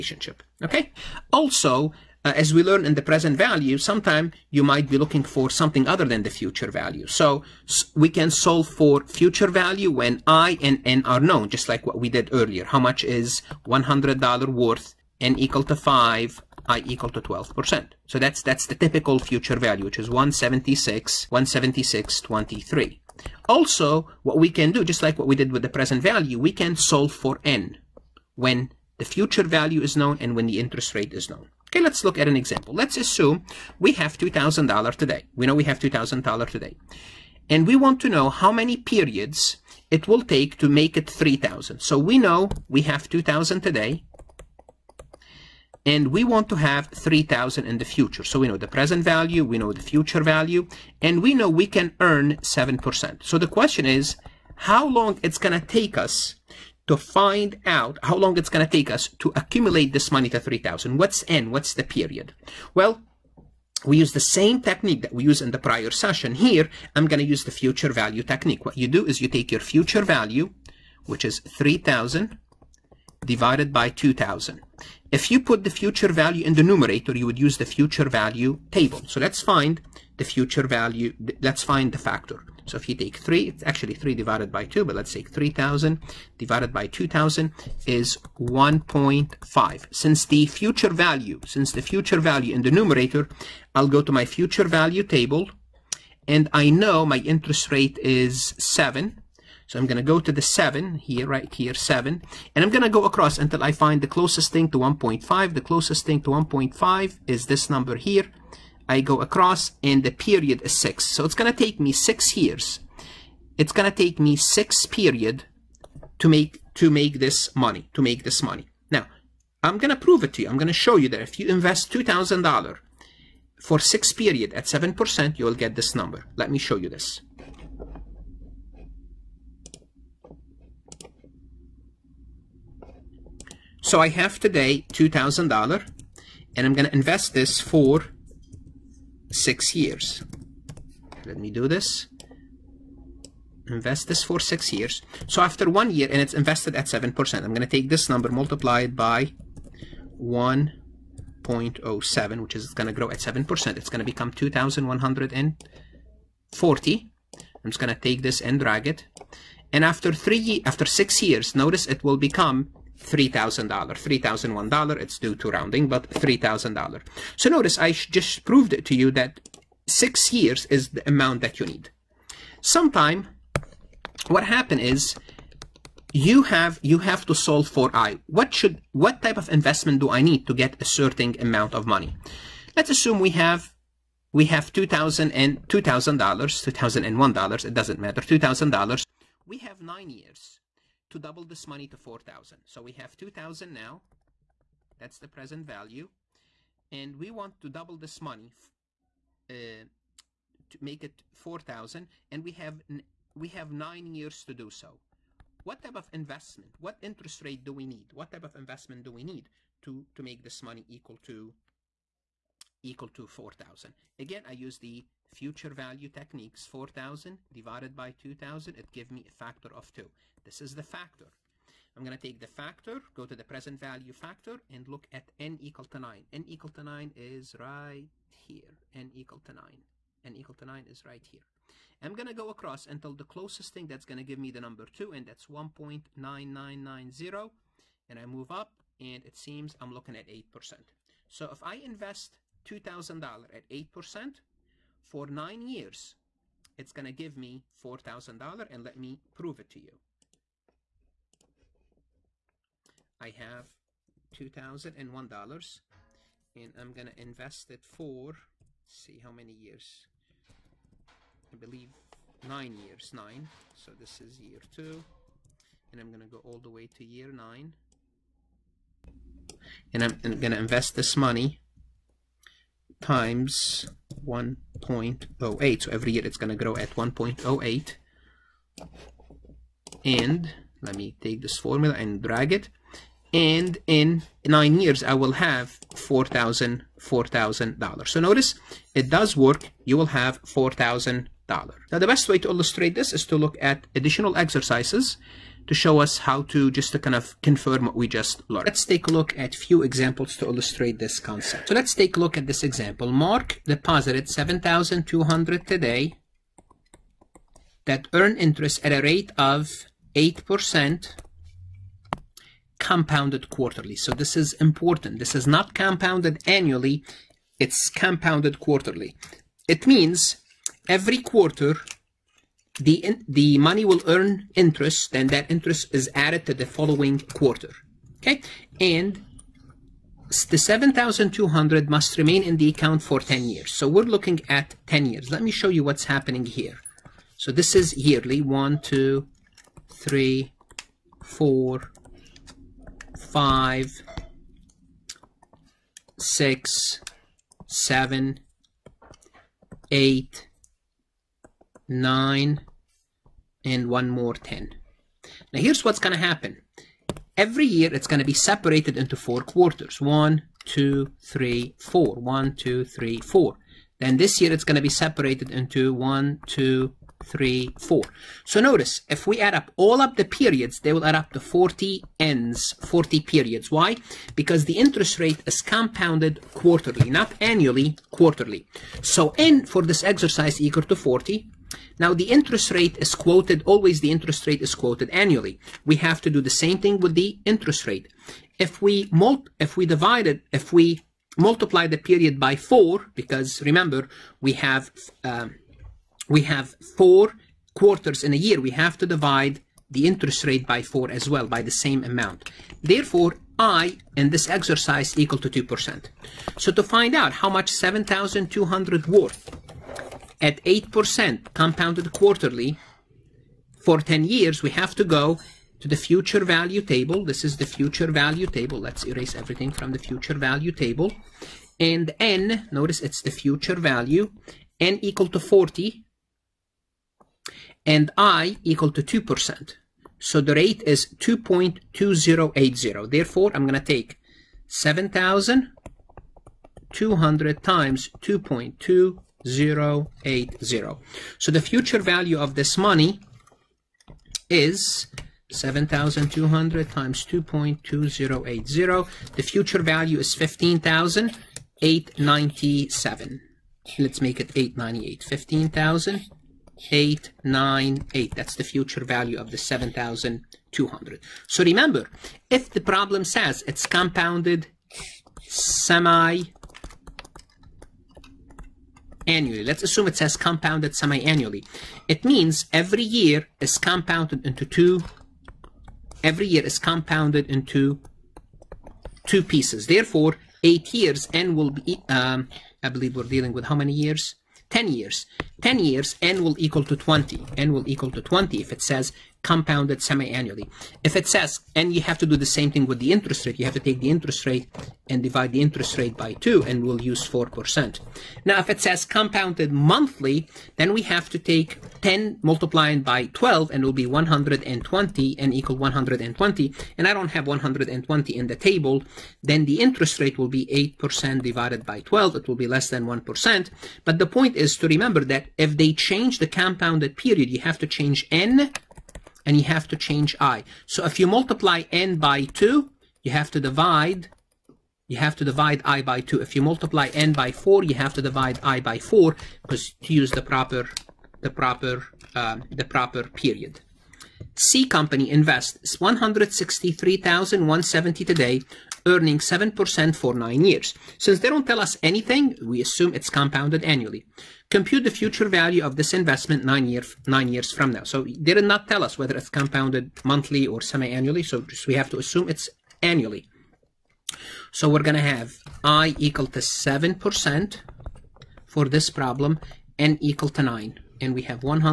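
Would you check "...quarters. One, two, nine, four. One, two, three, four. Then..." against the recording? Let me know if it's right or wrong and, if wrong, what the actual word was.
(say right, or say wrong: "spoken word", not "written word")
wrong: "three", not "nine".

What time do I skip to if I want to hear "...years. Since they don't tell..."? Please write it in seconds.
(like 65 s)
540 s.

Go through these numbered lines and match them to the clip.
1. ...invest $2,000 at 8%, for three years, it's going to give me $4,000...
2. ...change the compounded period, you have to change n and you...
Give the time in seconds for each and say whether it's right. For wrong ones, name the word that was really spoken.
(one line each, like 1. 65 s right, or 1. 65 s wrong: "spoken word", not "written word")
1. 241 s wrong: "nine", not "three"
2. 515 s right.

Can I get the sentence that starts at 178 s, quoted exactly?
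What should what type of investment do I need to get a certain amount of money?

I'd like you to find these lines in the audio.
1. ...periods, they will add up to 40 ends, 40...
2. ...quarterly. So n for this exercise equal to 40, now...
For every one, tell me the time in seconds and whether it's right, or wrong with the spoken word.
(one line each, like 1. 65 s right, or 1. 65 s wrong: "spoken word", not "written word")
1. 370 s right
2. 378 s right.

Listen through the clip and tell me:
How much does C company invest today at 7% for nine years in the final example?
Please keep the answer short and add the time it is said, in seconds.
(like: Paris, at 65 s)
163,170, at 535 s.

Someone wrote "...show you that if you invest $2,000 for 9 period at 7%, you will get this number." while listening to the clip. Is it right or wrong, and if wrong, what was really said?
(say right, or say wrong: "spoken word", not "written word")
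wrong: "6", not "9".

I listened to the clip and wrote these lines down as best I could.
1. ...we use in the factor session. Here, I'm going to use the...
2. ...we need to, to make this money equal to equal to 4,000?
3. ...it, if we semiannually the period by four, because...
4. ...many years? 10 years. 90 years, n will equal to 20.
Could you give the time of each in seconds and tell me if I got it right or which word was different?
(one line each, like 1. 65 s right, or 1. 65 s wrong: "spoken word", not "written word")
1. 65 s wrong: "prior", not "factor"
2. 209 s right
3. 390 s wrong: "multiply", not "semiannually"
4. 483 s wrong: "10", not "90".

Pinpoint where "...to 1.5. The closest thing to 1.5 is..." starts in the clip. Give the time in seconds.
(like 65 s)
104 s.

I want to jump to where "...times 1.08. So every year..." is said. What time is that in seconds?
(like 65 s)
273 s.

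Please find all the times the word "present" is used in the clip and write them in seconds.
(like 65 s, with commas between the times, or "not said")
3 s, 25 s, 48 s, 195 s, 223 s.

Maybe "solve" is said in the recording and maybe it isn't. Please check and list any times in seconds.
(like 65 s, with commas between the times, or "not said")
8 s, 26 s, 177 s.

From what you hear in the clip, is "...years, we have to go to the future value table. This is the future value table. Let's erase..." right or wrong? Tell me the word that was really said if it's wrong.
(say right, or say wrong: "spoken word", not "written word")
right.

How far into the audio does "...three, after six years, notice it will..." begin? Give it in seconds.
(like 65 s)
160 s.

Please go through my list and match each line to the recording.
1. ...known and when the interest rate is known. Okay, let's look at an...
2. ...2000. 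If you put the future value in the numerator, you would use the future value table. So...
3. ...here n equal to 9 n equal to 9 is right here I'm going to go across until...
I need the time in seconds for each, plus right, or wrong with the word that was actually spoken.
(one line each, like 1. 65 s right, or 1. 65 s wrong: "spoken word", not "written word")
1. 29 s right
2. 73 s right
3. 228 s right.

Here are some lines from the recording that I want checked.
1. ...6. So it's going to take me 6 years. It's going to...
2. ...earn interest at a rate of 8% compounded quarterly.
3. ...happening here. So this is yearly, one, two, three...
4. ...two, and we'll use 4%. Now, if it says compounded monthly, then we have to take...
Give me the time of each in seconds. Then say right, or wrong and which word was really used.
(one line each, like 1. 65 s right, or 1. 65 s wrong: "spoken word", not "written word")
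1. 110 s right
2. 308 s right
3. 336 s right
4. 496 s right.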